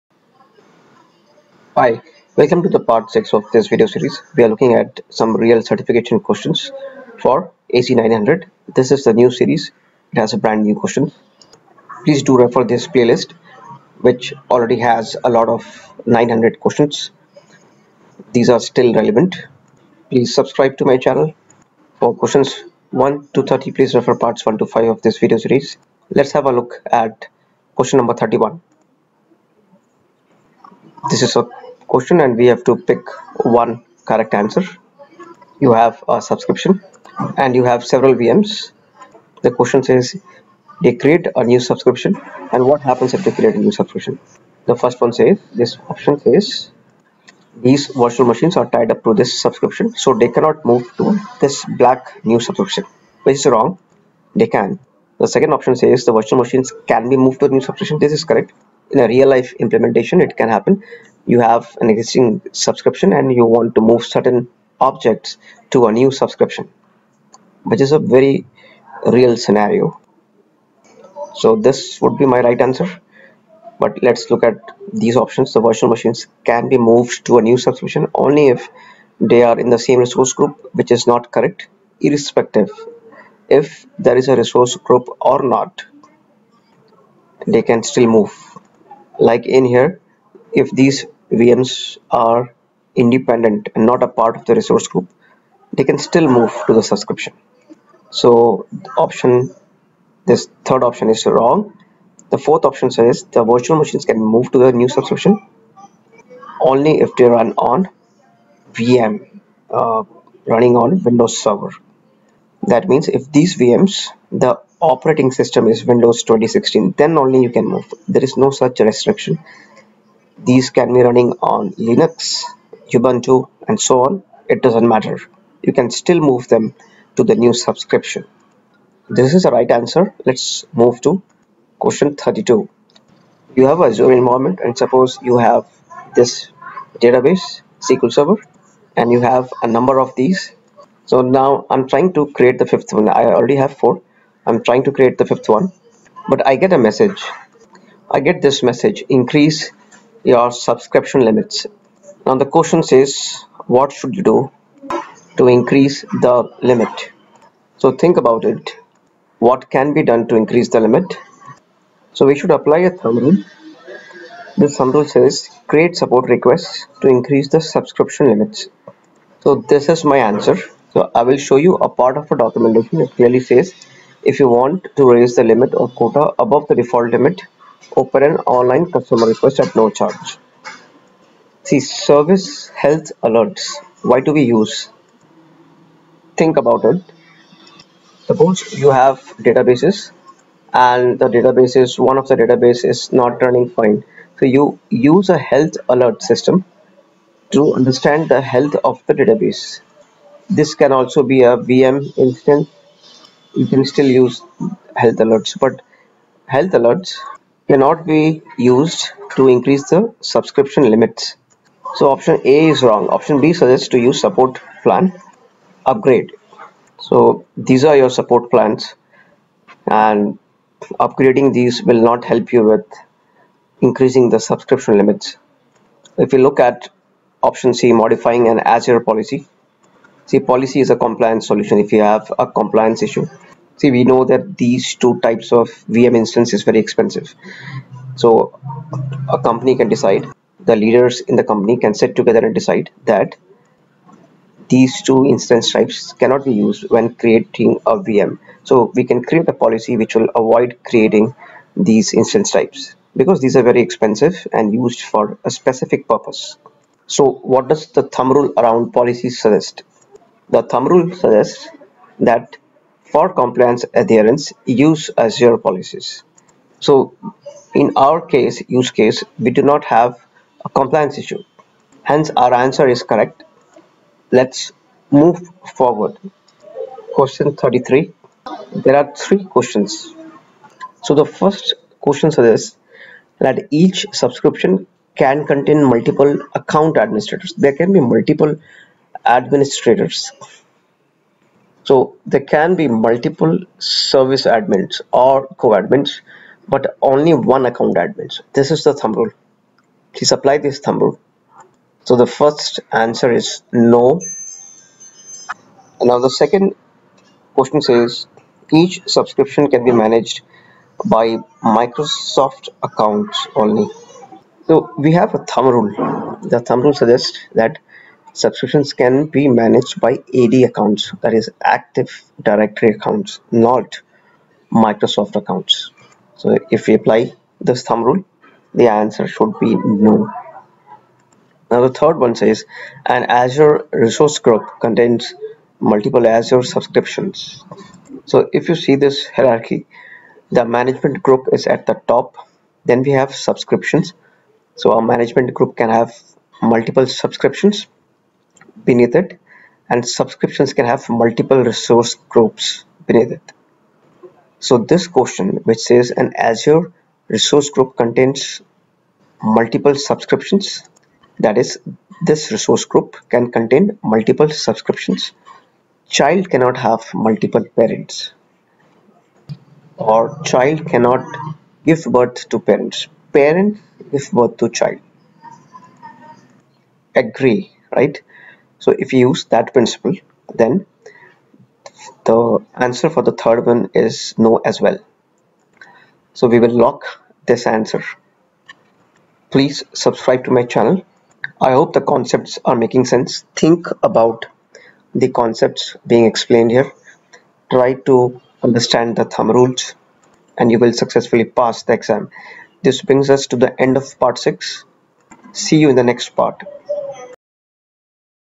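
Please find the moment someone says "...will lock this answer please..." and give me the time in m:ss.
6:26.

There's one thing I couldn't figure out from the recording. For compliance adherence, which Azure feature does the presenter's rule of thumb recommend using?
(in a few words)
Azure policies.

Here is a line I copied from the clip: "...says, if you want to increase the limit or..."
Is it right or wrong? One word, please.
wrong.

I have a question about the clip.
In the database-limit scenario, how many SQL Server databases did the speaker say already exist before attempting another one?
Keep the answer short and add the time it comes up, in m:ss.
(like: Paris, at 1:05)
4, at 2:23.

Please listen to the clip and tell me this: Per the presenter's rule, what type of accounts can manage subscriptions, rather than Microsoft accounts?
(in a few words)
Active Directory accounts.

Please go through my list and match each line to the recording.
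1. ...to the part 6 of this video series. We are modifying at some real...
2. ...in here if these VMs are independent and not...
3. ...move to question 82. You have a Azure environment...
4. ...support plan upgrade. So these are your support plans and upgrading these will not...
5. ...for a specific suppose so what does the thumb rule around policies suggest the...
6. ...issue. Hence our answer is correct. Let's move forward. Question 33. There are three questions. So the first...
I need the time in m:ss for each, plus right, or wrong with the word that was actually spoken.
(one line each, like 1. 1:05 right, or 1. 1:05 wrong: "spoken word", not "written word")
1. 0:02 wrong: "looking", not "modifying"
2. 1:29 right
3. 2:10 wrong: "32", not "82"
4. 3:34 right
5. 4:15 wrong: "purpose", not "suppose"
6. 4:31 right.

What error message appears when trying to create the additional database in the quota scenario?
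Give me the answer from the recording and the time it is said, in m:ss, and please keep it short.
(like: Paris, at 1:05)
Increase your subscription limits, at 2:29.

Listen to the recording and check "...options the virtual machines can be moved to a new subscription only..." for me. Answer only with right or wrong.
right.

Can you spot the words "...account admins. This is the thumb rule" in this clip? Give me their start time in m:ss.
4:57.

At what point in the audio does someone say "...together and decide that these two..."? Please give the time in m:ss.
4:02.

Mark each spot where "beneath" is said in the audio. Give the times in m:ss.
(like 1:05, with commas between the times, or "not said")
5:48, 5:53.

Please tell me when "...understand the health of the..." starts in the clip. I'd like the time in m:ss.
3:17.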